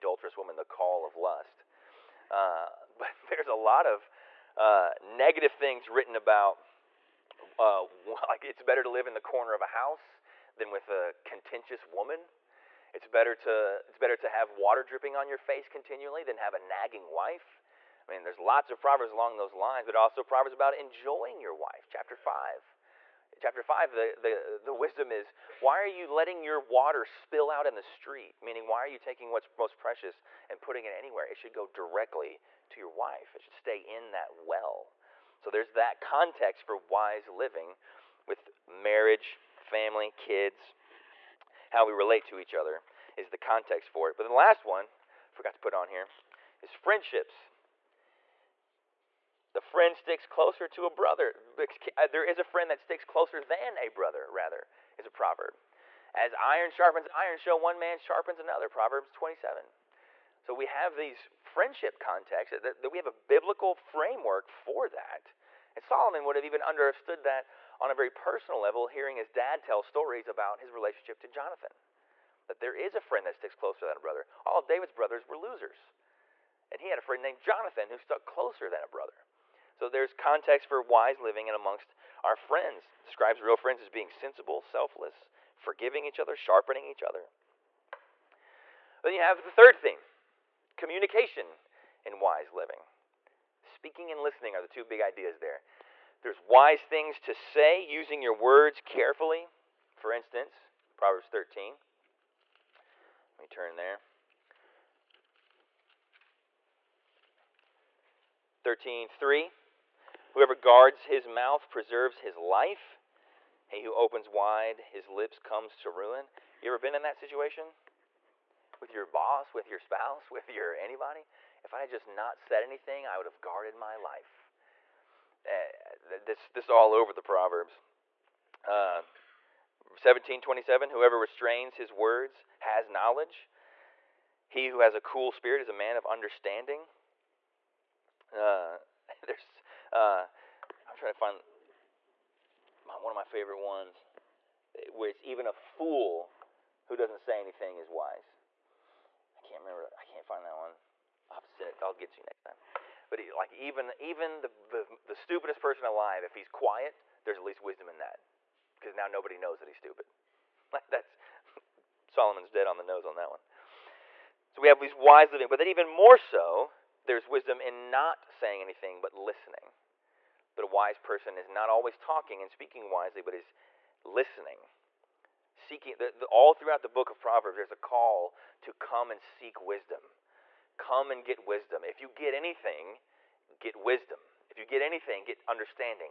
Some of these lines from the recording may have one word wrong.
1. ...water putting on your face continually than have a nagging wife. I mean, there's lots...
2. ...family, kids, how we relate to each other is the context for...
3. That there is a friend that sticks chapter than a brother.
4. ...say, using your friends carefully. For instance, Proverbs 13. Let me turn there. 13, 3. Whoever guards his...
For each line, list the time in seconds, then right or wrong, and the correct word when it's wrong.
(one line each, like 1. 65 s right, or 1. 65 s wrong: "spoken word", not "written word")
1. 14 s wrong: "dripping", not "putting"
2. 39 s right
3. 72 s wrong: "closer", not "chapter"
4. 97 s wrong: "words", not "friends".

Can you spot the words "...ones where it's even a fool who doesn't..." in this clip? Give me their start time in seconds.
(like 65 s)
143 s.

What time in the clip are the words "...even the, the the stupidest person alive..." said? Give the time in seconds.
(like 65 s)
153 s.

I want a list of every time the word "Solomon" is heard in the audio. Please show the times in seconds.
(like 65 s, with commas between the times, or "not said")
65 s, 162 s.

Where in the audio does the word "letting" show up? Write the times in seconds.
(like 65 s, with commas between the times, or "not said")
26 s.